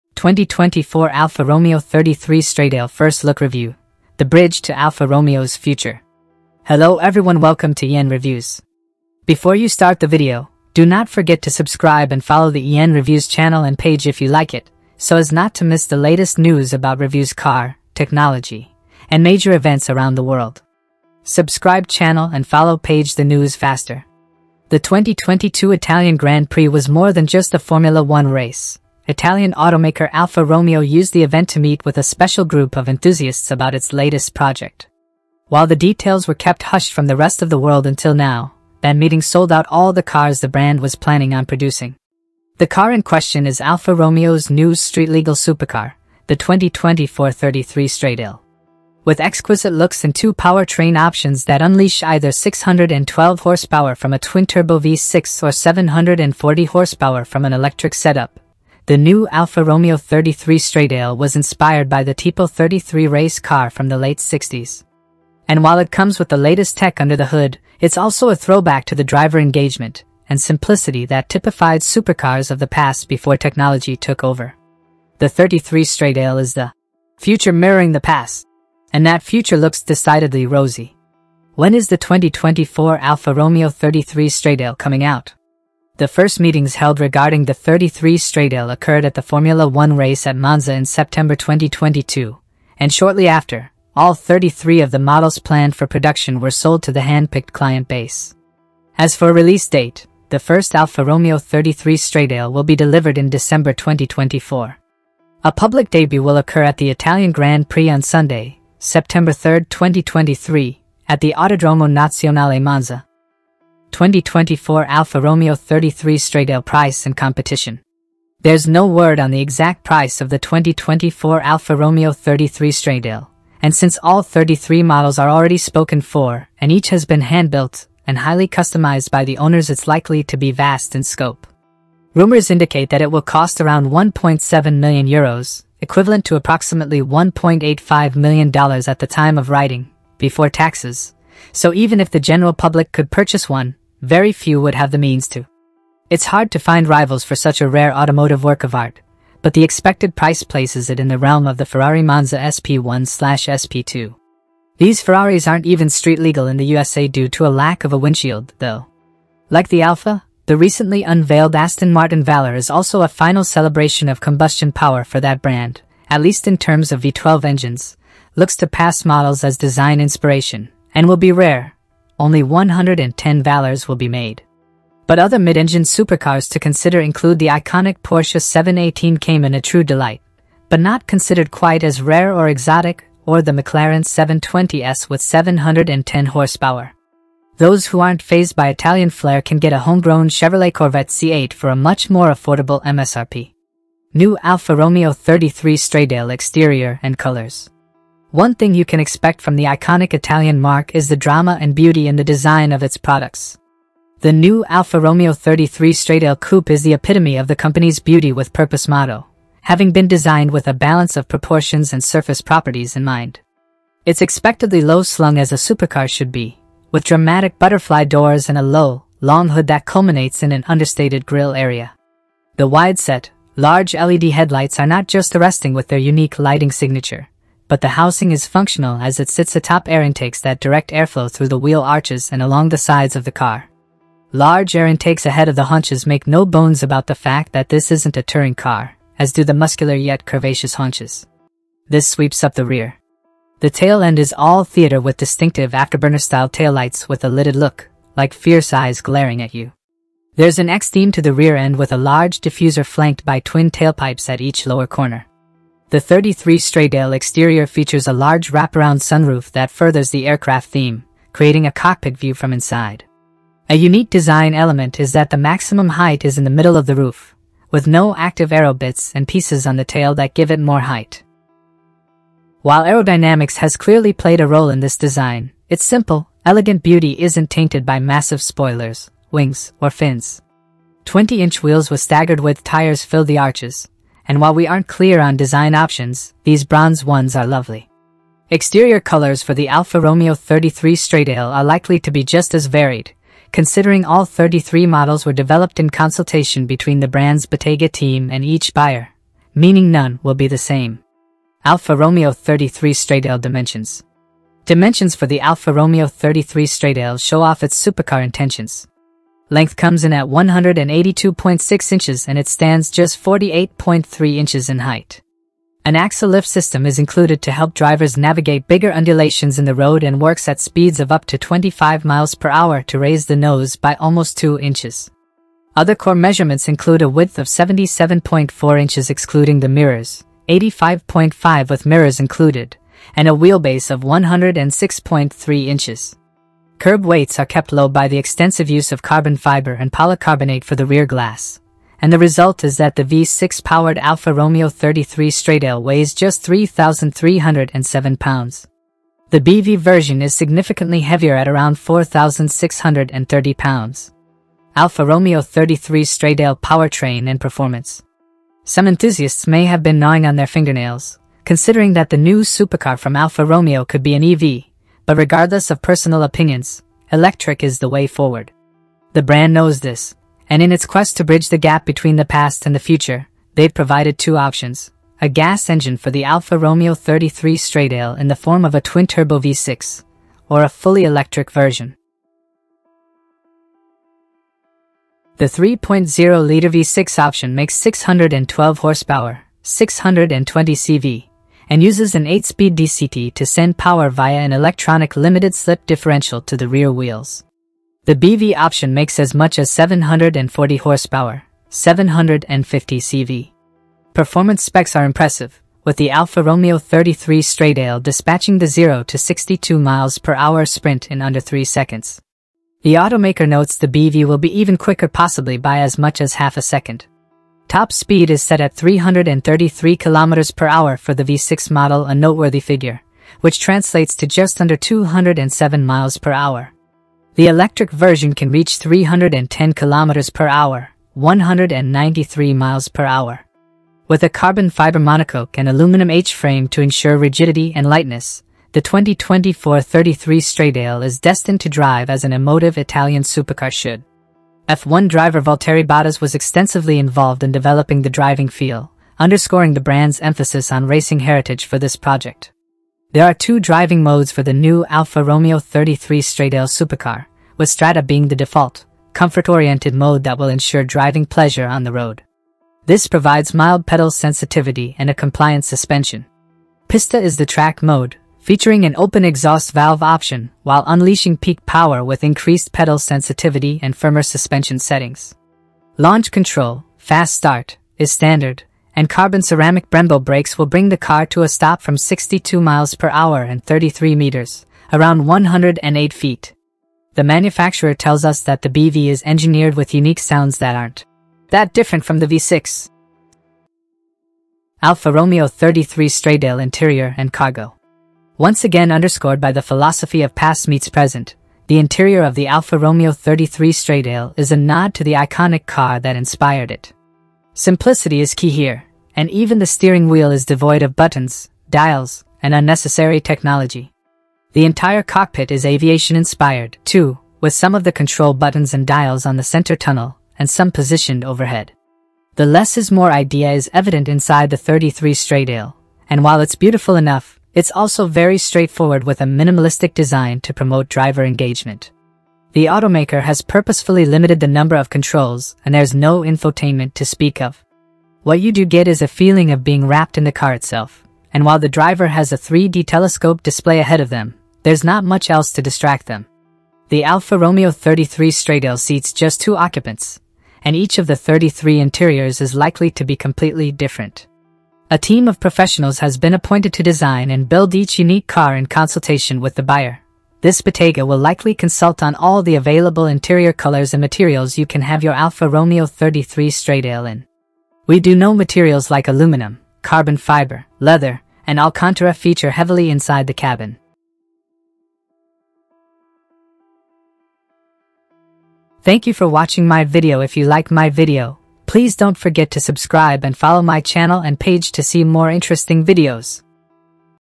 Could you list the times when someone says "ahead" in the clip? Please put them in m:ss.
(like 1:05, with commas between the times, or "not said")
3:55, 9:03.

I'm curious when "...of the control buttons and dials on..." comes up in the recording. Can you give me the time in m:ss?
8:37.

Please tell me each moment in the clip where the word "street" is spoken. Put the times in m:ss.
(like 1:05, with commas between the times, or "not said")
0:44, 2:35.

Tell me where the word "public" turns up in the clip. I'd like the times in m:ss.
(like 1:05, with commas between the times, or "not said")
1:45, 2:22.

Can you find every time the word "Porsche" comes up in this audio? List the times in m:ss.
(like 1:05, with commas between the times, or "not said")
2:58.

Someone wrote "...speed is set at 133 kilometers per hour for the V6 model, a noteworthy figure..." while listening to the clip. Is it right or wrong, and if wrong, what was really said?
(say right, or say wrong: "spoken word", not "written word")
wrong: "333", not "133".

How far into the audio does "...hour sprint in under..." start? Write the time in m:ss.
6:50.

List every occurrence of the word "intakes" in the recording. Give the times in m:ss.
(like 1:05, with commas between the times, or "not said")
3:50, 3:54.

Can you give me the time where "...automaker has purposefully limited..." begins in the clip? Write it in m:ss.
8:52.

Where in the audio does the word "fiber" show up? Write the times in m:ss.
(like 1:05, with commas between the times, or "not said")
5:39, 7:14, 9:30.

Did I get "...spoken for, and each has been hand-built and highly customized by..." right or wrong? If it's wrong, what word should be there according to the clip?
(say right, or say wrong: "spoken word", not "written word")
right.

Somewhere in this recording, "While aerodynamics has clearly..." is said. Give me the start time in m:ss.
4:32.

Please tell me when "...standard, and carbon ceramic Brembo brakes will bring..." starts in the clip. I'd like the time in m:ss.
7:58.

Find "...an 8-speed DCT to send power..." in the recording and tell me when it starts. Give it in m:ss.
6:32.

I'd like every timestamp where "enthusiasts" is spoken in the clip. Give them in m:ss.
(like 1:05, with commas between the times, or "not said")
0:32, 5:58.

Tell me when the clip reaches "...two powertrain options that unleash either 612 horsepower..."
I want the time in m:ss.
0:50.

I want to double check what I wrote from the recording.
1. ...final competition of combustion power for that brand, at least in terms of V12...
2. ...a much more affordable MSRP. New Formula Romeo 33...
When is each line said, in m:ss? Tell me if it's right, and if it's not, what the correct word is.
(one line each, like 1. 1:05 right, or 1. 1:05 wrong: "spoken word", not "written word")
1. 2:43 wrong: "celebration", not "competition"
2. 3:11 wrong: "Alfa", not "Formula".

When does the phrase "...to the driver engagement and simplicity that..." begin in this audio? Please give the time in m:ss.
1:08.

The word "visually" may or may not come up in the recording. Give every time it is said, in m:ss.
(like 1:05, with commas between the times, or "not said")
not said.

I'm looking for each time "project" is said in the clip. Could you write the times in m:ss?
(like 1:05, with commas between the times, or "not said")
0:34, 7:31.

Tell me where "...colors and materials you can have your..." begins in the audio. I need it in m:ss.
9:23.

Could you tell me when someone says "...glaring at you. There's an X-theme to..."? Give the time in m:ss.
4:08.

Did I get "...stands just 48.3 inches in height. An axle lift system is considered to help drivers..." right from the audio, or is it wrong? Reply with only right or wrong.
wrong.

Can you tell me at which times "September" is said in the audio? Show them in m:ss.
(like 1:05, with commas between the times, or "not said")
1:30, 1:48.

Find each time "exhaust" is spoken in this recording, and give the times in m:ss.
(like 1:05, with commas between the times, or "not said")
7:49.